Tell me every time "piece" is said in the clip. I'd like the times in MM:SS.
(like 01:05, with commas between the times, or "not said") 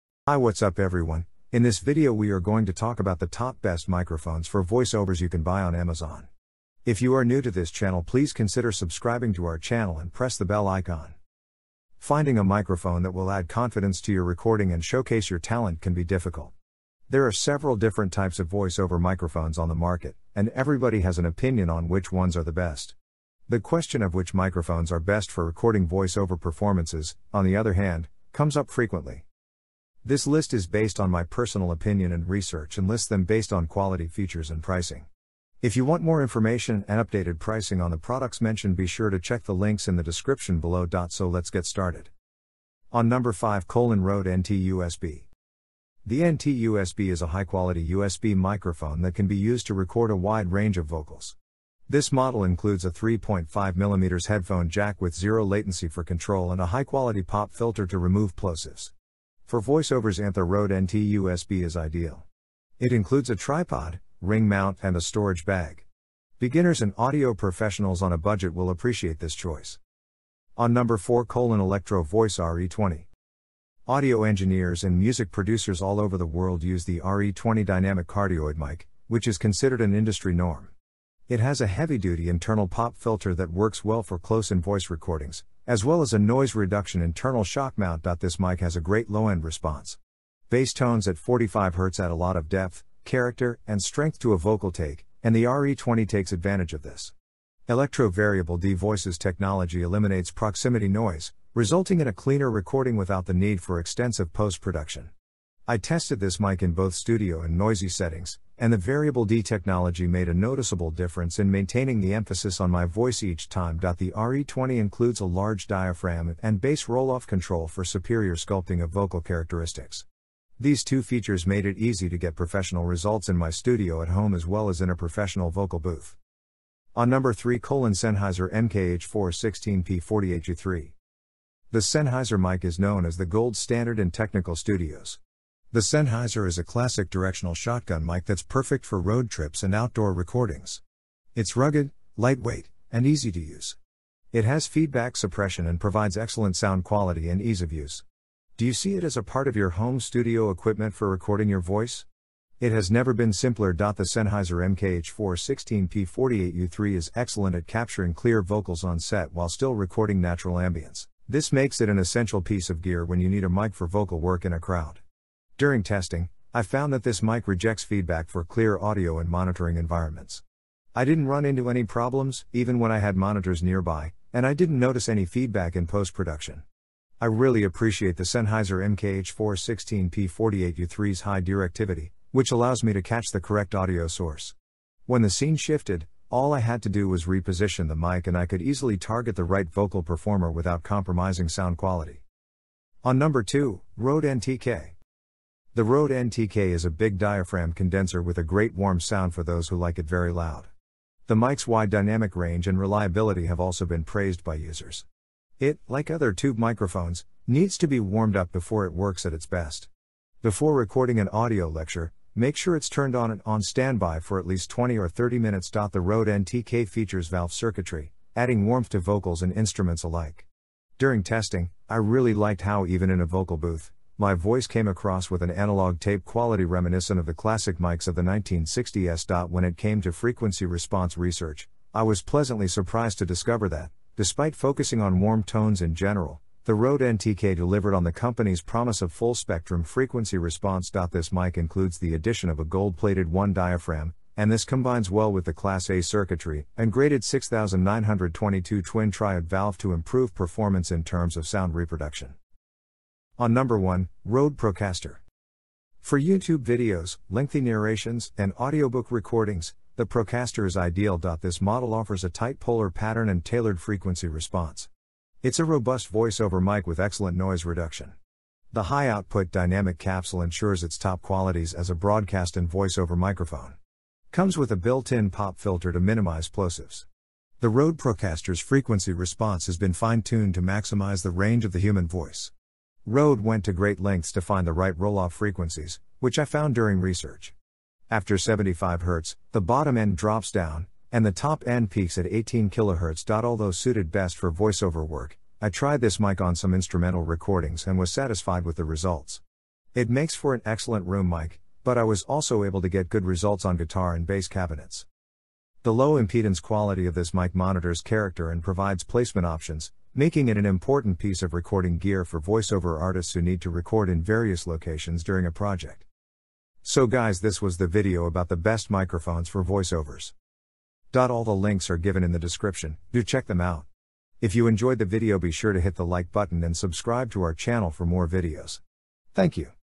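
02:42, 05:11.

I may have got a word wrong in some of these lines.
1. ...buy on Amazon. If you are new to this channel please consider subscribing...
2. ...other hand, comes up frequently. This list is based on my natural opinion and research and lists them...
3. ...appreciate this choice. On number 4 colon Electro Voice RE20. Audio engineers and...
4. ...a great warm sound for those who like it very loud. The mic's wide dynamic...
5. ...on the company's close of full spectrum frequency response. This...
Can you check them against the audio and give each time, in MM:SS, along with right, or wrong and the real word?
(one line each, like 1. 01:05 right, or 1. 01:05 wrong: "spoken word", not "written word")
1. 00:05 right
2. 00:27 wrong: "personal", not "natural"
3. 01:08 right
4. 03:18 right
5. 03:57 wrong: "promise", not "close".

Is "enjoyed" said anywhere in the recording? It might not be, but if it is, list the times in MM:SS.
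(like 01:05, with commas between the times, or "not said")
05:24.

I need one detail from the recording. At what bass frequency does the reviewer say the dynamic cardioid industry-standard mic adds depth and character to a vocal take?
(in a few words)
45Hz.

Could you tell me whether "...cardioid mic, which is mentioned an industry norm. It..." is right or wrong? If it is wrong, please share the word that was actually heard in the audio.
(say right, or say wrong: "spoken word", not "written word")
wrong: "considered", not "mentioned".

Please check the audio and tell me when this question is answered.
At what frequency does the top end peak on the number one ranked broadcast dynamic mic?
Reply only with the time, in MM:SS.
04:52.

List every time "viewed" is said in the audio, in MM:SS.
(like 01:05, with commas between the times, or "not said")
not said.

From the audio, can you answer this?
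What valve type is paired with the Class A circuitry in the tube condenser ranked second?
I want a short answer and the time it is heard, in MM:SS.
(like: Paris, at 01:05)
6922 twin triode, at 04:07.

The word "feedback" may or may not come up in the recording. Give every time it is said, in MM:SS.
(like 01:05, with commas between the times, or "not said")
02:24, 02:47, 02:55.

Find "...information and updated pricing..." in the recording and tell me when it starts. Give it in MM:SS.
00:36.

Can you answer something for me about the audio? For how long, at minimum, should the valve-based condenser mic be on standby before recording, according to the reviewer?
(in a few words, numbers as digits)
20 minutes.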